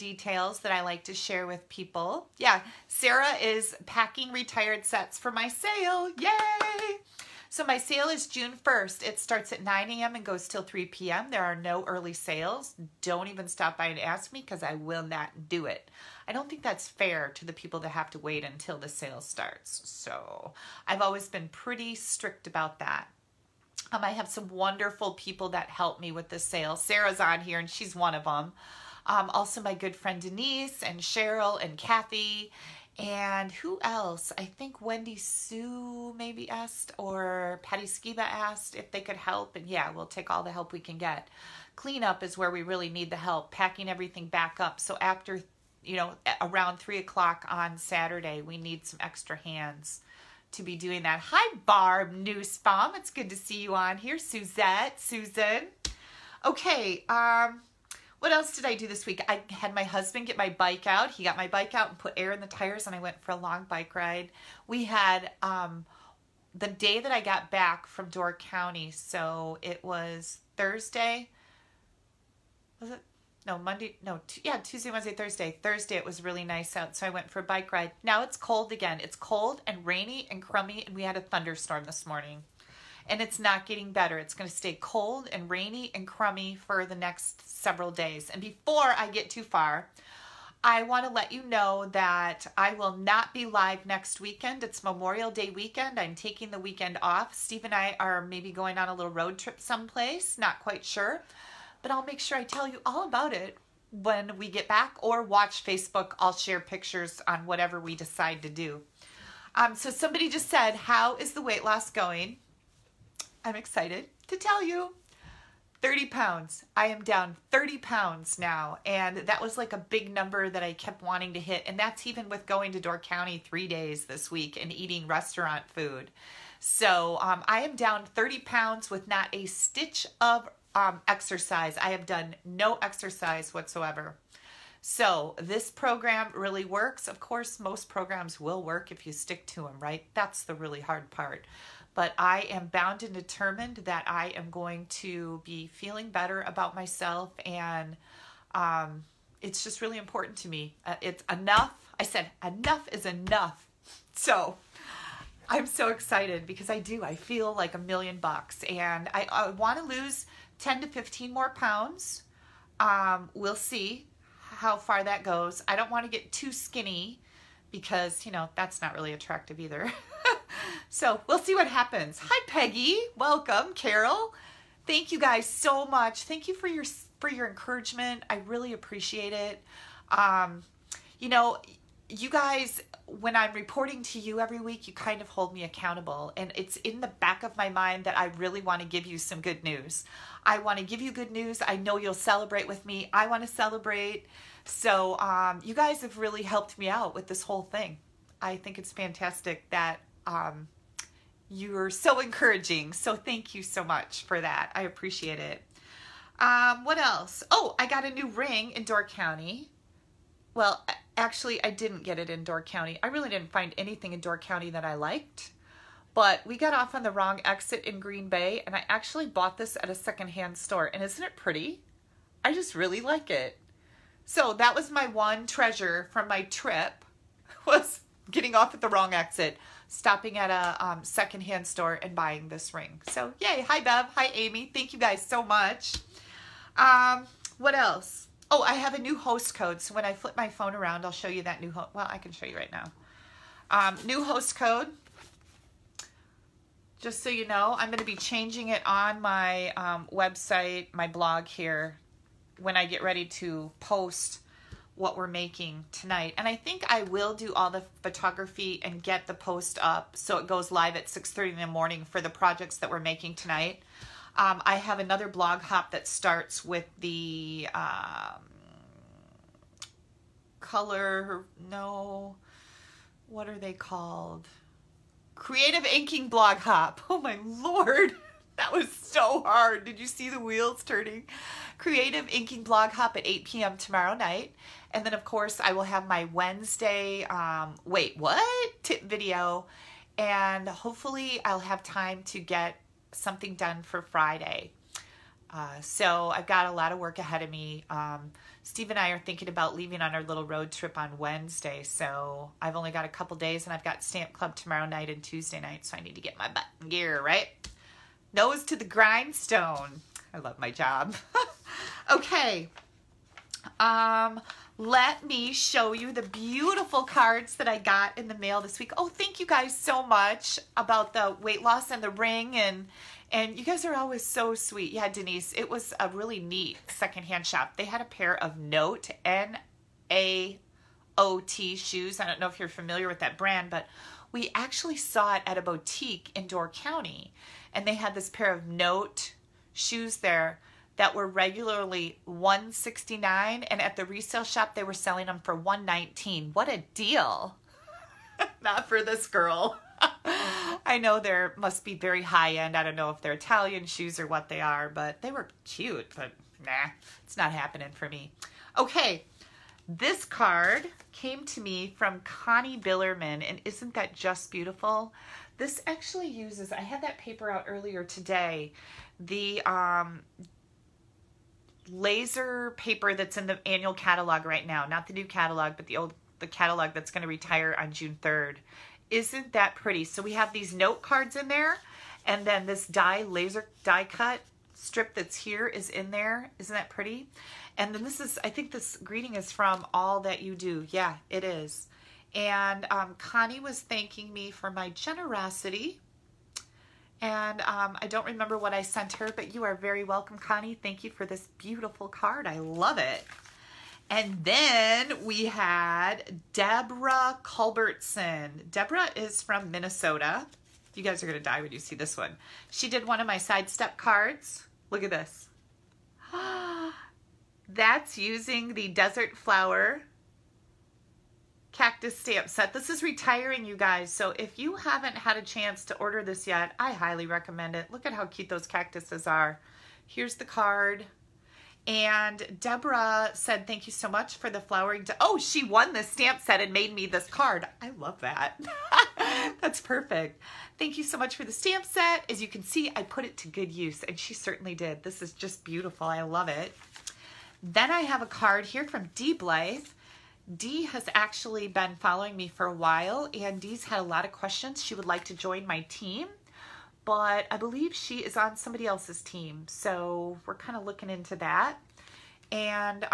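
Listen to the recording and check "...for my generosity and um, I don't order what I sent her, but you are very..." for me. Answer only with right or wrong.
wrong.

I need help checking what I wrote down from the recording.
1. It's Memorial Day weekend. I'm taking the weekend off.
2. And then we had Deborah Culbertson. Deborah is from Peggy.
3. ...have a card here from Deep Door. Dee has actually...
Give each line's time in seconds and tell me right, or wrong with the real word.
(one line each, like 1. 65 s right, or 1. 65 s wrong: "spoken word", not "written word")
1. 94 s right
2. 404 s wrong: "Minnesota", not "Peggy"
3. 448 s wrong: "Life", not "Door".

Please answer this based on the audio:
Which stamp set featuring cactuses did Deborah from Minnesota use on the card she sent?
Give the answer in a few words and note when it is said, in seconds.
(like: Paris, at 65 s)
Desert Flower, at 418 s.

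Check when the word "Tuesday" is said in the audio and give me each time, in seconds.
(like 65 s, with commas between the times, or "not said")
74 s, 305 s.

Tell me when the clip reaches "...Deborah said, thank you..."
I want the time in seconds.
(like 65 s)
432 s.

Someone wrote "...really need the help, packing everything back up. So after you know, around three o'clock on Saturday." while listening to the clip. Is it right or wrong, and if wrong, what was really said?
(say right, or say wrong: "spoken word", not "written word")
right.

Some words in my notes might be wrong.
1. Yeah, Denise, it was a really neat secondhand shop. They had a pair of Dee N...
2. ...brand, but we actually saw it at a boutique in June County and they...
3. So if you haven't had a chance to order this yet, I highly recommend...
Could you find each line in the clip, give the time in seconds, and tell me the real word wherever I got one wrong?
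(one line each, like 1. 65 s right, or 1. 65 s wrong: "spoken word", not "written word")
1. 324 s wrong: "Note", not "Dee"
2. 333 s wrong: "Door", not "June"
3. 424 s right.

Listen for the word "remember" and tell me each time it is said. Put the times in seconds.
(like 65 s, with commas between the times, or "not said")
398 s.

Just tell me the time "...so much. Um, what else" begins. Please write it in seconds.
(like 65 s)
235 s.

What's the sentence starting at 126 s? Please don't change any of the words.
So um, I am down 30 pounds with not a stitch of um, exercise.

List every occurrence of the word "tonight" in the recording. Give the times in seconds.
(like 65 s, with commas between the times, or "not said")
255 s, 263 s.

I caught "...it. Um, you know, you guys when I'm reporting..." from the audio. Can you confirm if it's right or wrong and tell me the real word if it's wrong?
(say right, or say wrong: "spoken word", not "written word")
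right.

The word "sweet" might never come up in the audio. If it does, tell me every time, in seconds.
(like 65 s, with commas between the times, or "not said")
324 s.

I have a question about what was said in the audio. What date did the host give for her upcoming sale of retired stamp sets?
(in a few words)
June 1st.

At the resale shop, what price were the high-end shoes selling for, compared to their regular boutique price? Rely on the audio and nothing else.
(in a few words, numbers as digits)
$119.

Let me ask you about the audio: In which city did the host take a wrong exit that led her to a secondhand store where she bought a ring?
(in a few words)
Green Bay.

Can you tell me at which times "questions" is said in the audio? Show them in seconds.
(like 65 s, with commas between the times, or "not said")
454 s.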